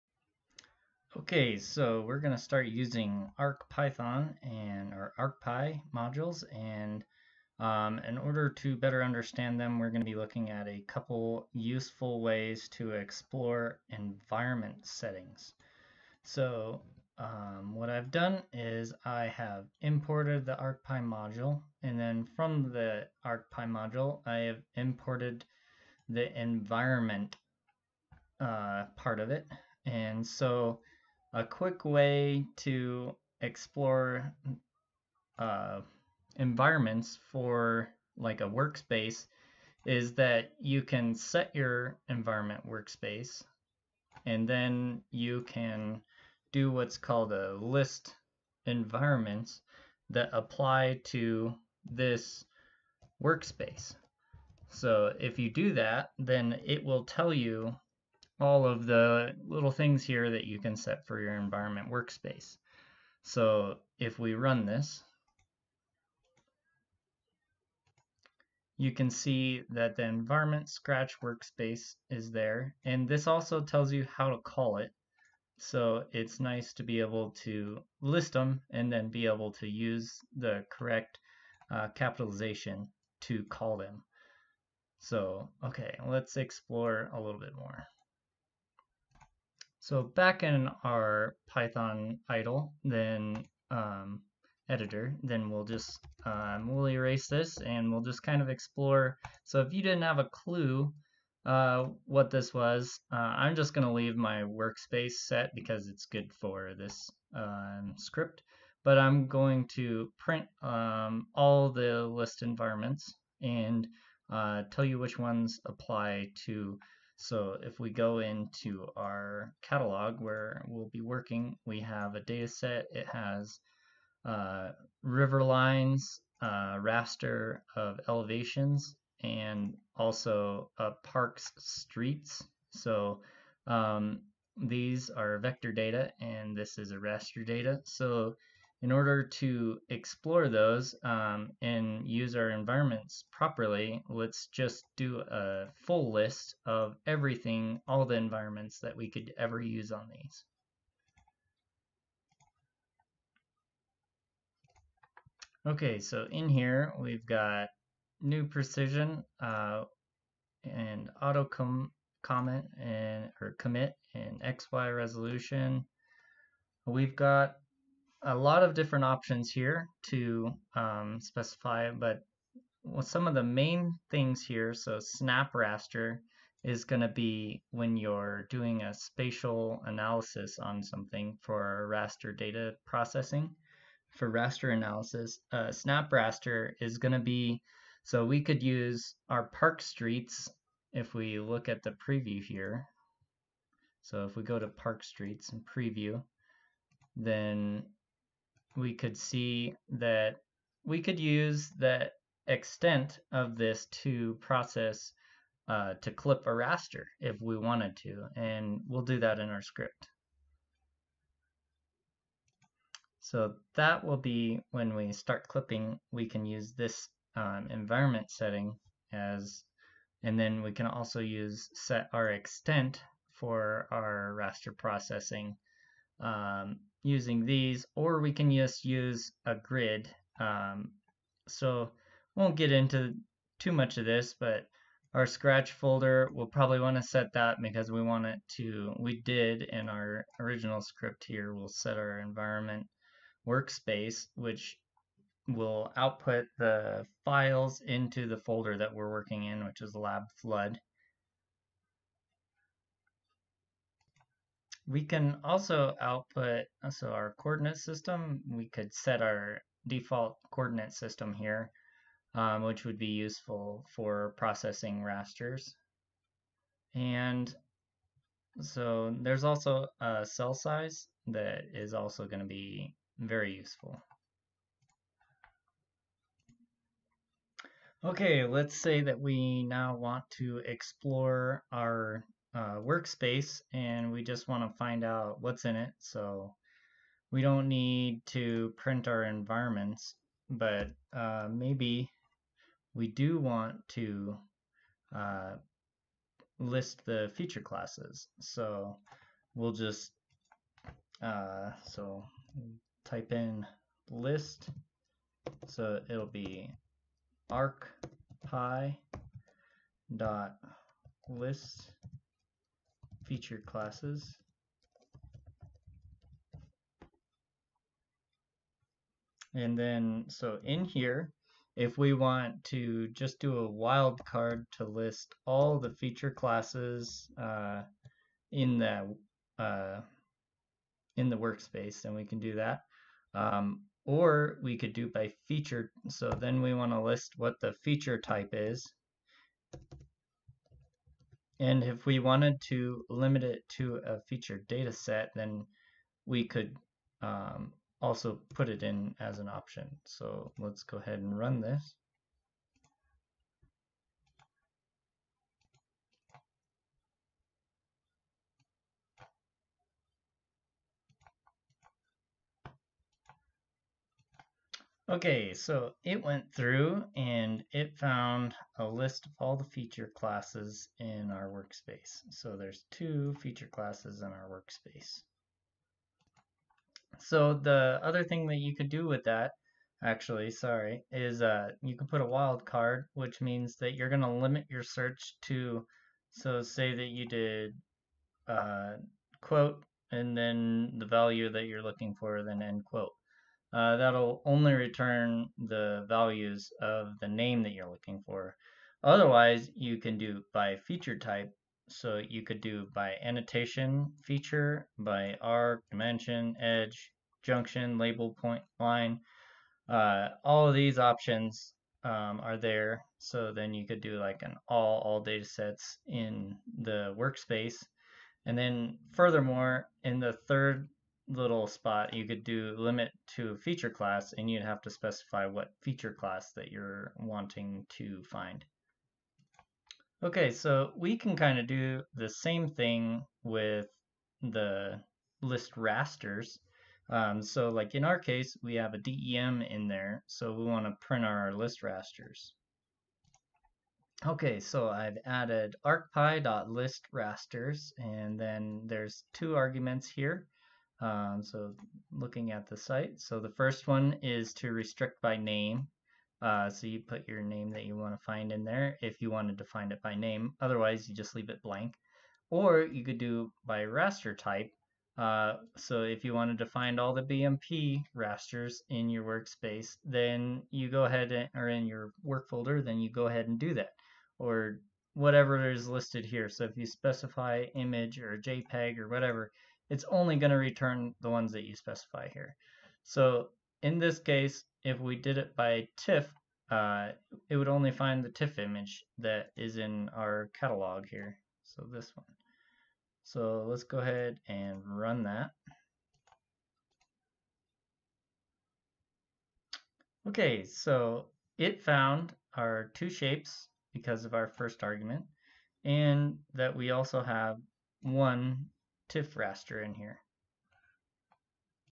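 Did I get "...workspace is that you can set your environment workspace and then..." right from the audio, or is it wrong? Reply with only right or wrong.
right.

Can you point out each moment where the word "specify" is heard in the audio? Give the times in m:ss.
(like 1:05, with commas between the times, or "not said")
2:51, 7:04, 7:56, 8:01.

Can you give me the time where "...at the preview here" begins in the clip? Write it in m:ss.
3:11.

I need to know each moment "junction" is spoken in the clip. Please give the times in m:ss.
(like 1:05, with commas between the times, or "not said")
6:47.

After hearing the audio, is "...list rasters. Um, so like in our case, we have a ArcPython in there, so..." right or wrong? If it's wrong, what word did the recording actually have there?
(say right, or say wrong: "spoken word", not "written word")
wrong: "DEM", not "ArcPython".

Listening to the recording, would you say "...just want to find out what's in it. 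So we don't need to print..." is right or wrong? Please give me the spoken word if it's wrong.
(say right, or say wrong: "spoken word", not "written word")
right.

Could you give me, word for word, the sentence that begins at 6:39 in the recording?
Otherwise, you can do by feature type.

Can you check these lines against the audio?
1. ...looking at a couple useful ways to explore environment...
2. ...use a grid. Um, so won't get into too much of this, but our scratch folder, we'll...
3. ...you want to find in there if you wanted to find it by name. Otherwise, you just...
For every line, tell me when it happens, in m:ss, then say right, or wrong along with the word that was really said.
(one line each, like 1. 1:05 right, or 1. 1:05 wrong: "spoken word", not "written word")
1. 0:10 right
2. 3:48 right
3. 7:37 right.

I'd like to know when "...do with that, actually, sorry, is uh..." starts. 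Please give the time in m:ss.
6:18.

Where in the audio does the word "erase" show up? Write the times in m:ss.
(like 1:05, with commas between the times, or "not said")
1:36.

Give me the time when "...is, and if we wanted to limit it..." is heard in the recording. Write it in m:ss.
5:38.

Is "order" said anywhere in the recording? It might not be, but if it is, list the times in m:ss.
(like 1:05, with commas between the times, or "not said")
0:08, 2:18.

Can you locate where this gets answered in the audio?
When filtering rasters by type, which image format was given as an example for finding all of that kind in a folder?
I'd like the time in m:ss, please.
7:47.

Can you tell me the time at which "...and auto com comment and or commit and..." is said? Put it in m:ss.
2:40.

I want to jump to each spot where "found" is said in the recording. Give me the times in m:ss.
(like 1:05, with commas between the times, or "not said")
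6:07, 8:21.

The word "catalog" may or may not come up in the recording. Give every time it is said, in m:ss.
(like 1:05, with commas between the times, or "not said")
1:59, 8:10.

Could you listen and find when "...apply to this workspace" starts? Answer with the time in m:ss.
0:50.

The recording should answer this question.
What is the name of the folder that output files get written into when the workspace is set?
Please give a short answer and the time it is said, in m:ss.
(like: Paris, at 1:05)
lab flood, at 4:09.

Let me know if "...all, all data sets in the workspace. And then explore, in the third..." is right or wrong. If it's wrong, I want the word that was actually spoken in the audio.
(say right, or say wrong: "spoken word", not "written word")
wrong: "furthermore", not "explore".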